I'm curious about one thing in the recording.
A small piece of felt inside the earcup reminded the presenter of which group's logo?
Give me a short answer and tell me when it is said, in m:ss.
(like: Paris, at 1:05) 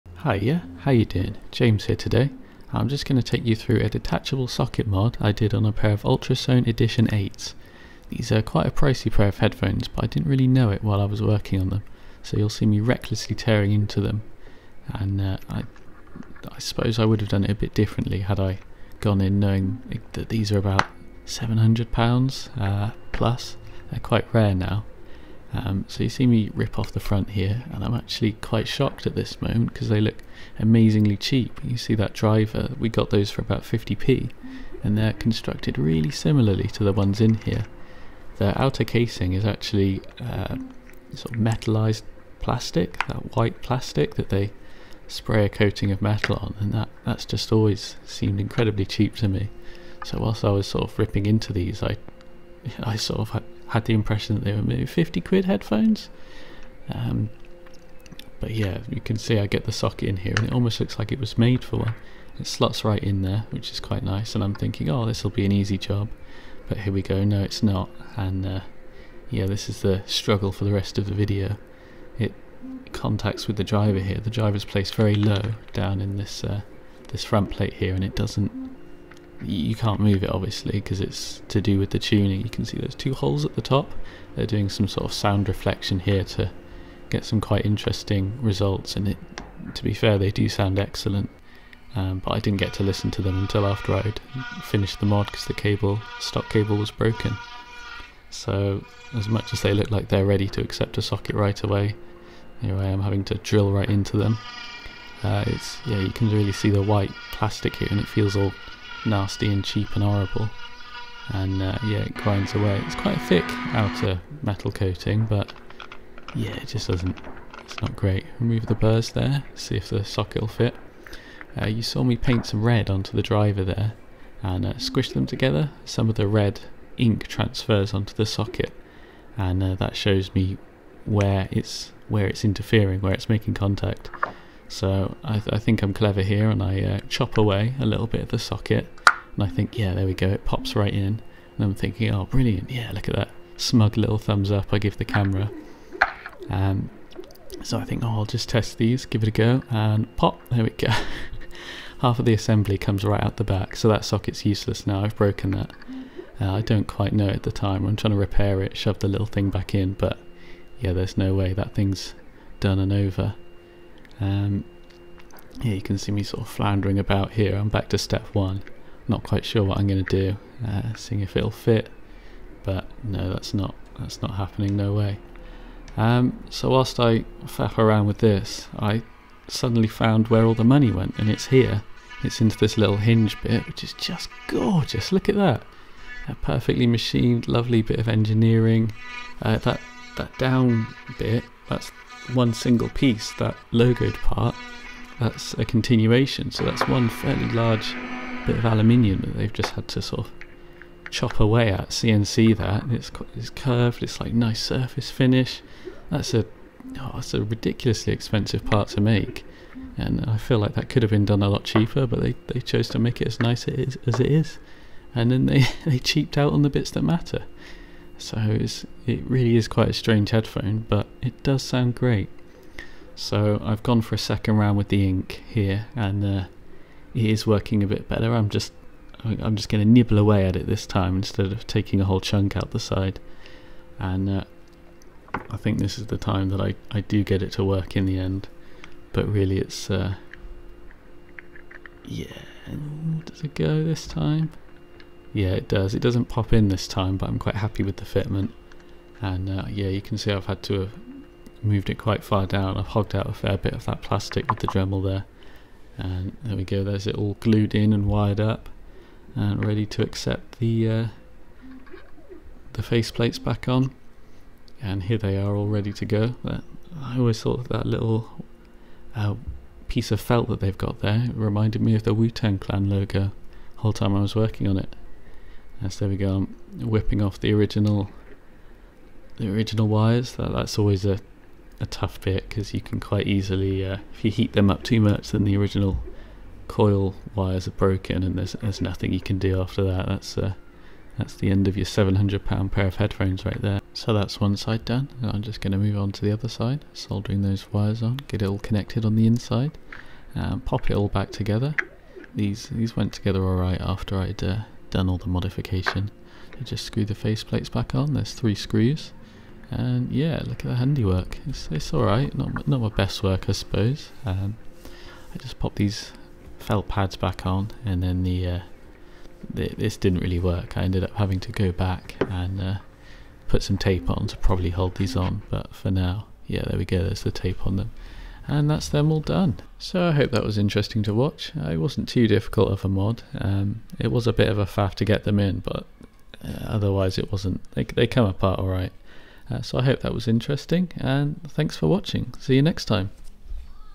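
Wu-Tang Clan, at 4:32.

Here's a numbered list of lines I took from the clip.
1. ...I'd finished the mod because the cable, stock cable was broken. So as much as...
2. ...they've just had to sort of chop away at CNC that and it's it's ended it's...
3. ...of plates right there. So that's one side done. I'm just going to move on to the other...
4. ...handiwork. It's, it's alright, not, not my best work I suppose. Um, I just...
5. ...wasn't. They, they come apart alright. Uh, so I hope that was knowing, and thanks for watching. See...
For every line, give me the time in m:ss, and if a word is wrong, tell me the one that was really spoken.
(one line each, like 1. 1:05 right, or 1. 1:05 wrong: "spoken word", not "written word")
1. 1:33 right
2. 3:19 wrong: "curved", not "ended"
3. 4:52 wrong: "headphones", not "plates"
4. 5:10 right
5. 5:37 wrong: "interesting", not "knowing".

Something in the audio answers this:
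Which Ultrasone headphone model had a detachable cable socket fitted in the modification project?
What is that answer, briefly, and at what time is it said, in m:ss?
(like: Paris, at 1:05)
Edition 8, at 0:06.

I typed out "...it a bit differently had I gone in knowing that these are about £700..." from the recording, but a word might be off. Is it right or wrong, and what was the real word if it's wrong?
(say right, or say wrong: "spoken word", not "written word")
right.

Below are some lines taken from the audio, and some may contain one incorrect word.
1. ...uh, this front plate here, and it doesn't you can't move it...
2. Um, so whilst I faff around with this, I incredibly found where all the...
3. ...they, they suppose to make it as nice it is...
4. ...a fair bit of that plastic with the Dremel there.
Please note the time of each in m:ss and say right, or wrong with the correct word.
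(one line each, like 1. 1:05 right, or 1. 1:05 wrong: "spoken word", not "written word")
1. 1:16 right
2. 2:55 wrong: "suddenly", not "incredibly"
3. 3:32 wrong: "chose", not "suppose"
4. 4:13 right.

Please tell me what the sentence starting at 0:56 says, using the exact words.
Um, but yeah, you can see I get the socket in here and it almost looks like it was made for one.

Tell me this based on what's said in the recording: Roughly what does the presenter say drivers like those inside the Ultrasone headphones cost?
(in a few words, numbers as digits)
50p.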